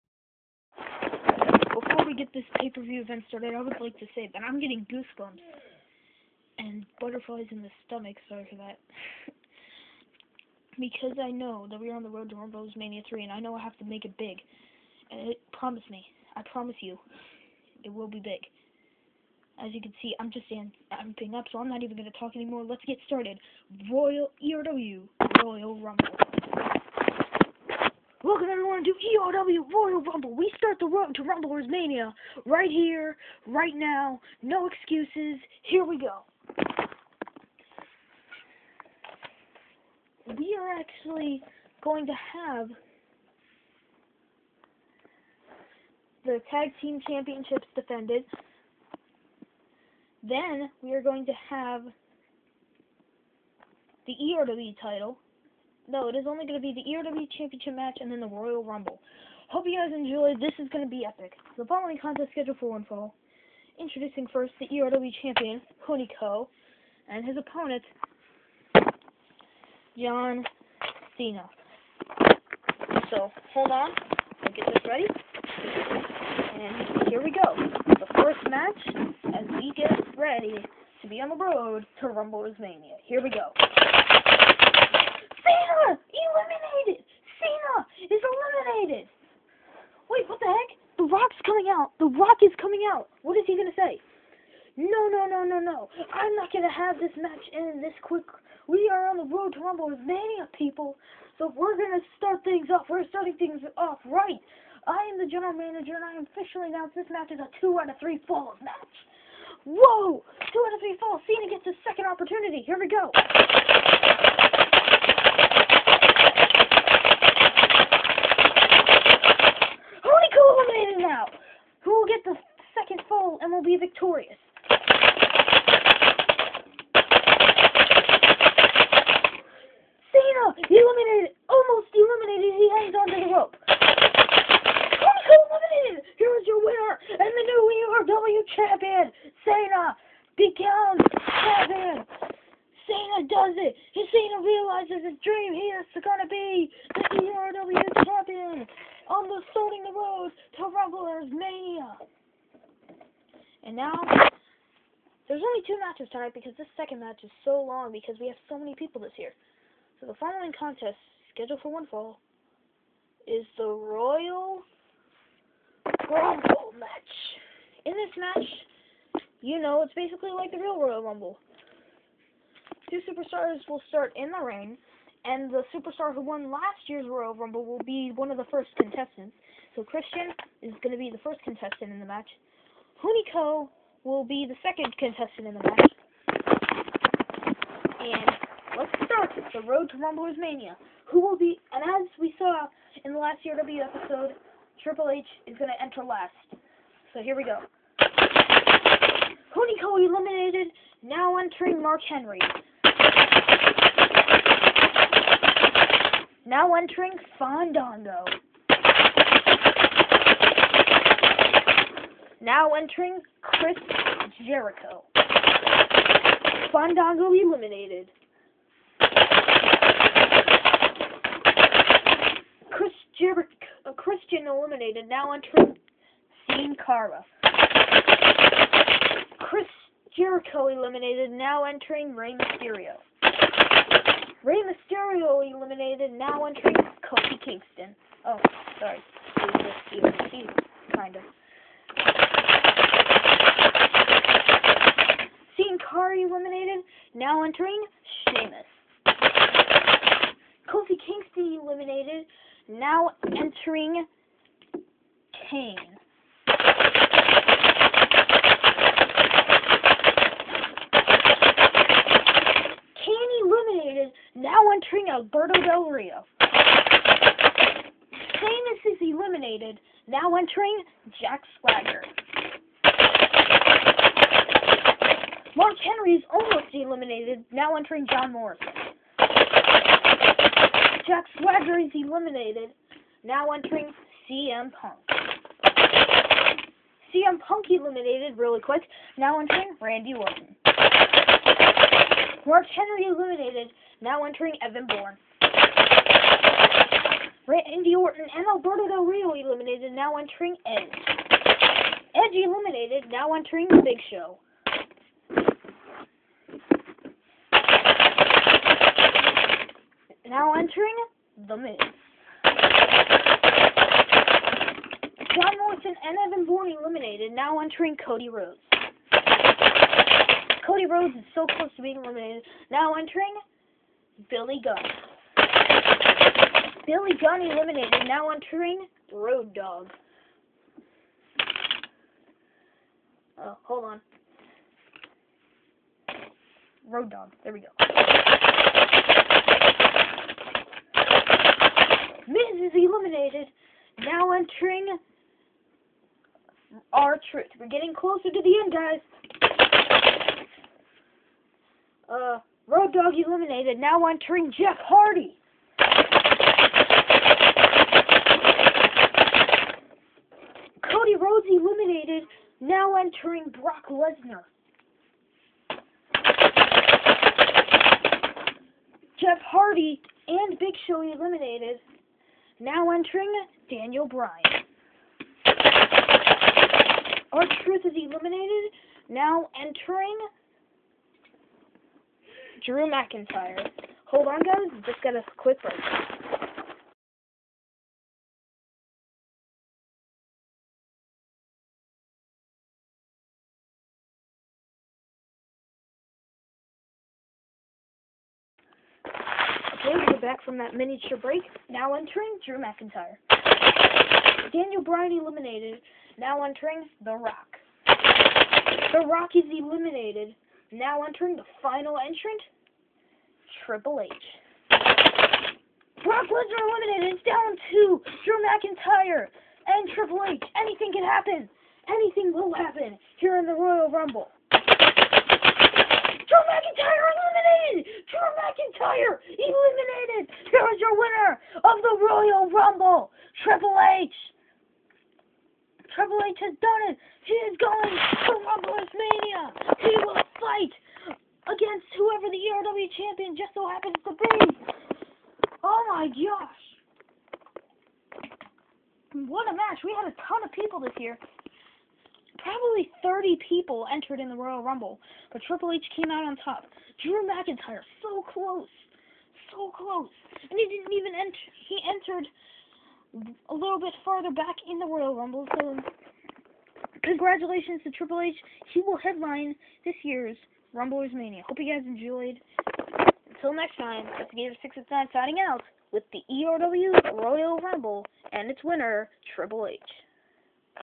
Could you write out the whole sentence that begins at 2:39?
So the following contest, scheduled for one fall, is the Royal Rumble match.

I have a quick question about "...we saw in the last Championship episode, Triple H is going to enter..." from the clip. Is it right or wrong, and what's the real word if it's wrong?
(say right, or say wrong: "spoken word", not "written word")
wrong: "ERW", not "Championship".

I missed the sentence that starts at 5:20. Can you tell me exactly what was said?
Cody Rhodes is so close to being eliminated.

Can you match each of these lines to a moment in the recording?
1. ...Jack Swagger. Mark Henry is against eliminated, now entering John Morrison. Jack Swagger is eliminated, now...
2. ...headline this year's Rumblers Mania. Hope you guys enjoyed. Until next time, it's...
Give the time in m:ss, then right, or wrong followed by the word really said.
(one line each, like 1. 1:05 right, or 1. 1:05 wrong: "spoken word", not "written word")
1. 4:31 wrong: "almost", not "against"
2. 7:48 right.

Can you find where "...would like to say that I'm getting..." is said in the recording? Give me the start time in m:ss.
0:03.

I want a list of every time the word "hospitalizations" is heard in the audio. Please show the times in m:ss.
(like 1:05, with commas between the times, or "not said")
not said.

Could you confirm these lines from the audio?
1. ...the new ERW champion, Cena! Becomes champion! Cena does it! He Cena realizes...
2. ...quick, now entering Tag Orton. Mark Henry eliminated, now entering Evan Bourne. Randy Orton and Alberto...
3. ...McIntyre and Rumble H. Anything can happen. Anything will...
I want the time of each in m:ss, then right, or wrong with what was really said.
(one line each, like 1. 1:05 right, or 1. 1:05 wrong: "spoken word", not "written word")
1. 2:17 right
2. 4:48 wrong: "Randy", not "Tag"
3. 6:58 wrong: "Triple", not "Rumble".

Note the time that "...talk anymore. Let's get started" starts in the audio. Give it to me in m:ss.
0:22.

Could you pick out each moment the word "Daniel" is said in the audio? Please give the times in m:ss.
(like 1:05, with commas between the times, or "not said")
6:13, 6:44.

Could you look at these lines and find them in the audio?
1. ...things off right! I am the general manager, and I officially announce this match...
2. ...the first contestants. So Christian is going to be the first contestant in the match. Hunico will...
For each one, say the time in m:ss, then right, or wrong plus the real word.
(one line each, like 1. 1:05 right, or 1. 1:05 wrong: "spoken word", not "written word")
1. 1:43 right
2. 2:58 right.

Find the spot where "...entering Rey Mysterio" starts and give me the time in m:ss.
3:51.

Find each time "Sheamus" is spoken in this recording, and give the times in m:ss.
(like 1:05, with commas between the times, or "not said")
4:08, 4:26.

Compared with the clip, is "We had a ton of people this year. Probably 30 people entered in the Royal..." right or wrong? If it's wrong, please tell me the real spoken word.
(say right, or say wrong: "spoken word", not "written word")
right.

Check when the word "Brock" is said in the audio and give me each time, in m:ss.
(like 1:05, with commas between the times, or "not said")
6:03, 6:56.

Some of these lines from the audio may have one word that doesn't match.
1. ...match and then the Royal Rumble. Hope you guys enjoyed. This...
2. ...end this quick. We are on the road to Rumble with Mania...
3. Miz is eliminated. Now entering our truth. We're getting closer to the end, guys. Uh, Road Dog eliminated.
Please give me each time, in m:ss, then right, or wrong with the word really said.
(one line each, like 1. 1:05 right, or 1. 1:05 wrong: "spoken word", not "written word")
1. 0:57 right
2. 1:37 right
3. 5:42 right.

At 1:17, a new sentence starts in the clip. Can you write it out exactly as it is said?
The first match as we get ready to be on the road to Rumble Mania.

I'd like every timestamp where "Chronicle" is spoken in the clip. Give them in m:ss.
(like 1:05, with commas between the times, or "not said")
2:13.